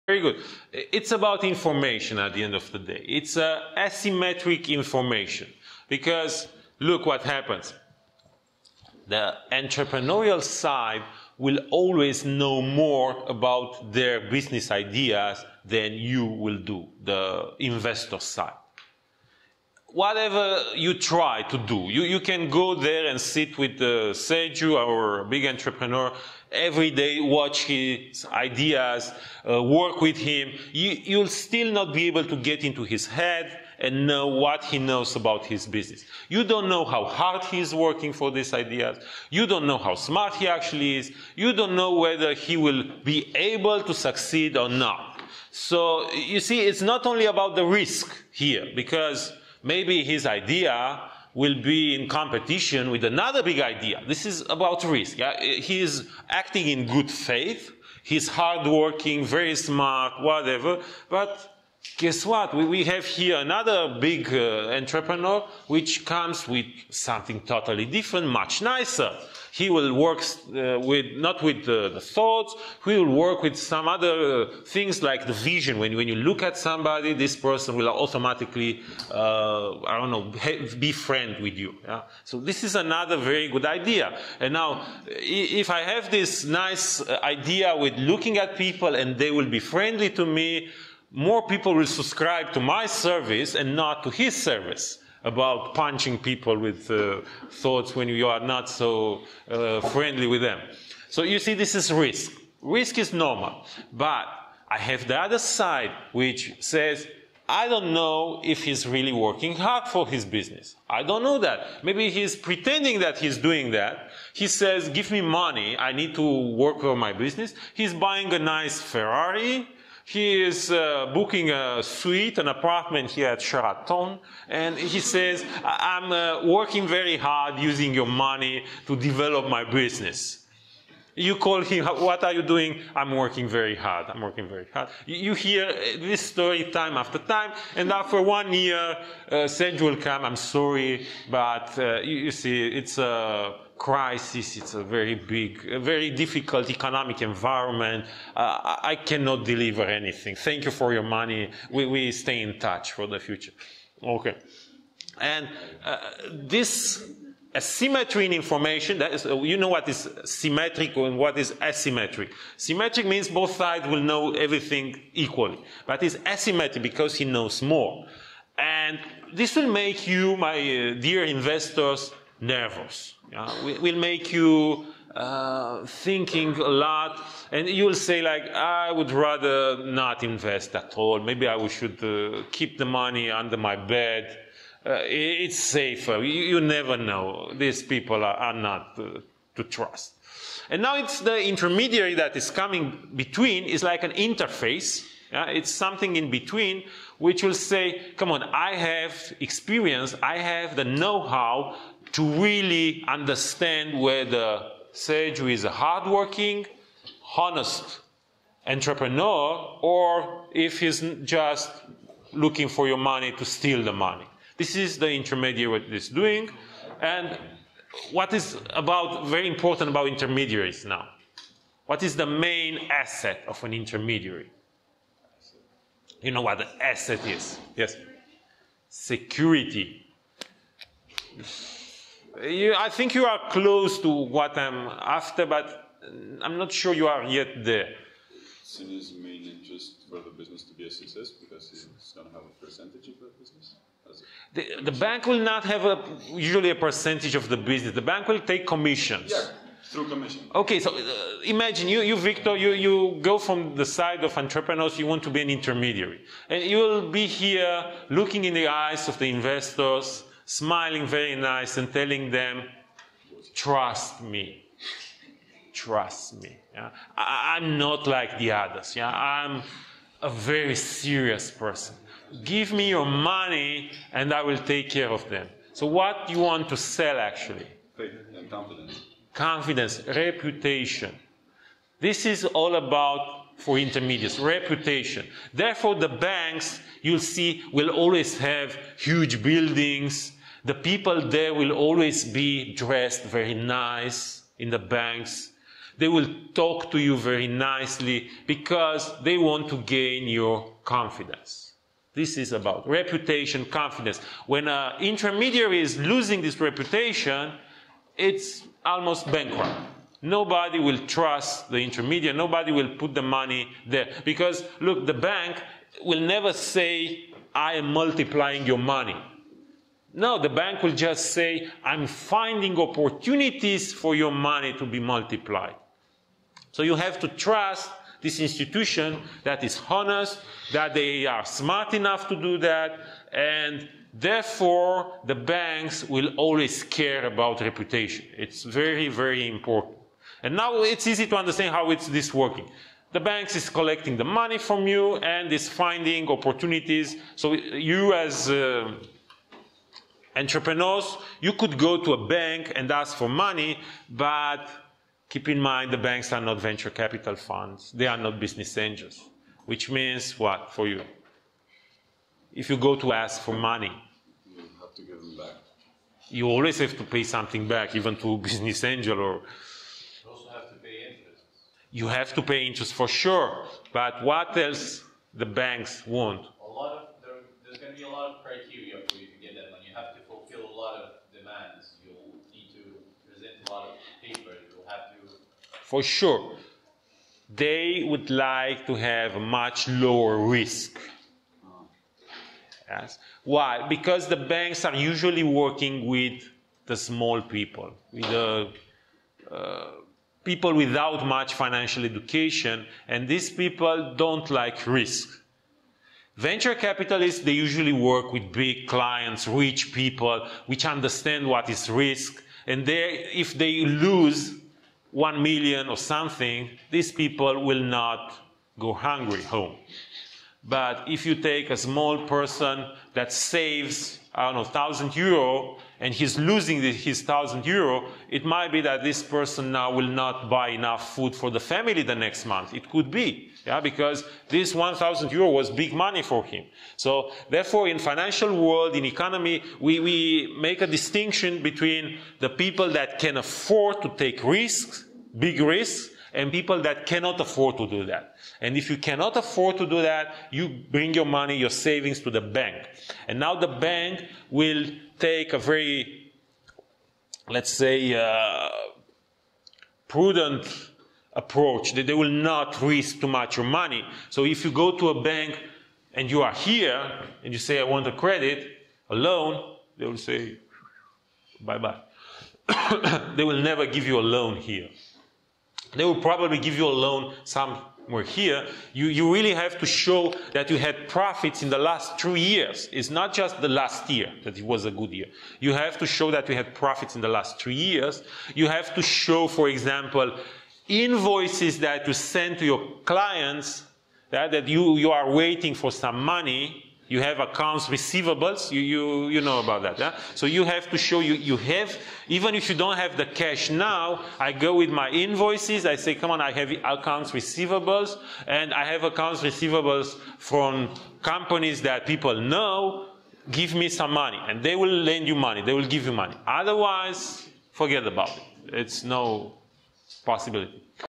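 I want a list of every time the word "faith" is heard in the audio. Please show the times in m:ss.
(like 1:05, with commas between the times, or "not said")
0:57, 4:37.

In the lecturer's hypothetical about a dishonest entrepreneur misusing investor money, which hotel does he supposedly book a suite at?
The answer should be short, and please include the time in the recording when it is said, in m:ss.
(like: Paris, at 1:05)
Sheraton, at 2:03.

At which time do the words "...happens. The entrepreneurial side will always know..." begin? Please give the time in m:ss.
0:07.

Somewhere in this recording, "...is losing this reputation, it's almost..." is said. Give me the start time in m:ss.
5:05.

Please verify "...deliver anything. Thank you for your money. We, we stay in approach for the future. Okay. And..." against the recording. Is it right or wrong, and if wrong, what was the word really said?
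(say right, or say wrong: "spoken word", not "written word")
wrong: "touch", not "approach".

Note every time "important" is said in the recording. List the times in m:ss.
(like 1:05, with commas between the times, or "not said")
3:39, 5:39.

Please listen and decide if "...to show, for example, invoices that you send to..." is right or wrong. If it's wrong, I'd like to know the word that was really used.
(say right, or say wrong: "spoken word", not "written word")
right.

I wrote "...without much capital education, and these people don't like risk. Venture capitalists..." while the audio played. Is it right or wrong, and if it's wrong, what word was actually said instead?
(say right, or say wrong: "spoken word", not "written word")
wrong: "financial", not "capital".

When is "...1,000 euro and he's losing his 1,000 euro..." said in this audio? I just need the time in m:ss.
7:04.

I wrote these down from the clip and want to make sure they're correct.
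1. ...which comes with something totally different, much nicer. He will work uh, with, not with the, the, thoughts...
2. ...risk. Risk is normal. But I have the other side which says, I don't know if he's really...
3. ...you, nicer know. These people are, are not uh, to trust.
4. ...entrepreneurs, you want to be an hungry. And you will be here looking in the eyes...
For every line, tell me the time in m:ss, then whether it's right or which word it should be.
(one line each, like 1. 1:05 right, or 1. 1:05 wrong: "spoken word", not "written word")
1. 1:05 right
2. 1:41 right
3. 3:06 wrong: "never", not "nicer"
4. 4:14 wrong: "intermediary", not "hungry".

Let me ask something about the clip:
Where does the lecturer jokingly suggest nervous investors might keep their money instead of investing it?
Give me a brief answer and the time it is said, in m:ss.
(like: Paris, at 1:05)
under my bed, at 3:03.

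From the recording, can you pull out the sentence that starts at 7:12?
It could be, yeah, because this 1,000 euro was big money for him.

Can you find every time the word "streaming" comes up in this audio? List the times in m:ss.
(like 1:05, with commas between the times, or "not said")
not said.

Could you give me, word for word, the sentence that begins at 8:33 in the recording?
Give me some money and they will lend you money.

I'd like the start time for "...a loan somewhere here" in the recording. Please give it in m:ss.
7:56.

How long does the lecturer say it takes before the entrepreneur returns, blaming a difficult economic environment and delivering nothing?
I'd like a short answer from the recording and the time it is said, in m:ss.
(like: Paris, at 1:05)
one year, at 2:18.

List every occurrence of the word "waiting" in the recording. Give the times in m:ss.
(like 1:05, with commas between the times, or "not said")
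8:15.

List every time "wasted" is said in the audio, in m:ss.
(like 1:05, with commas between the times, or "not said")
not said.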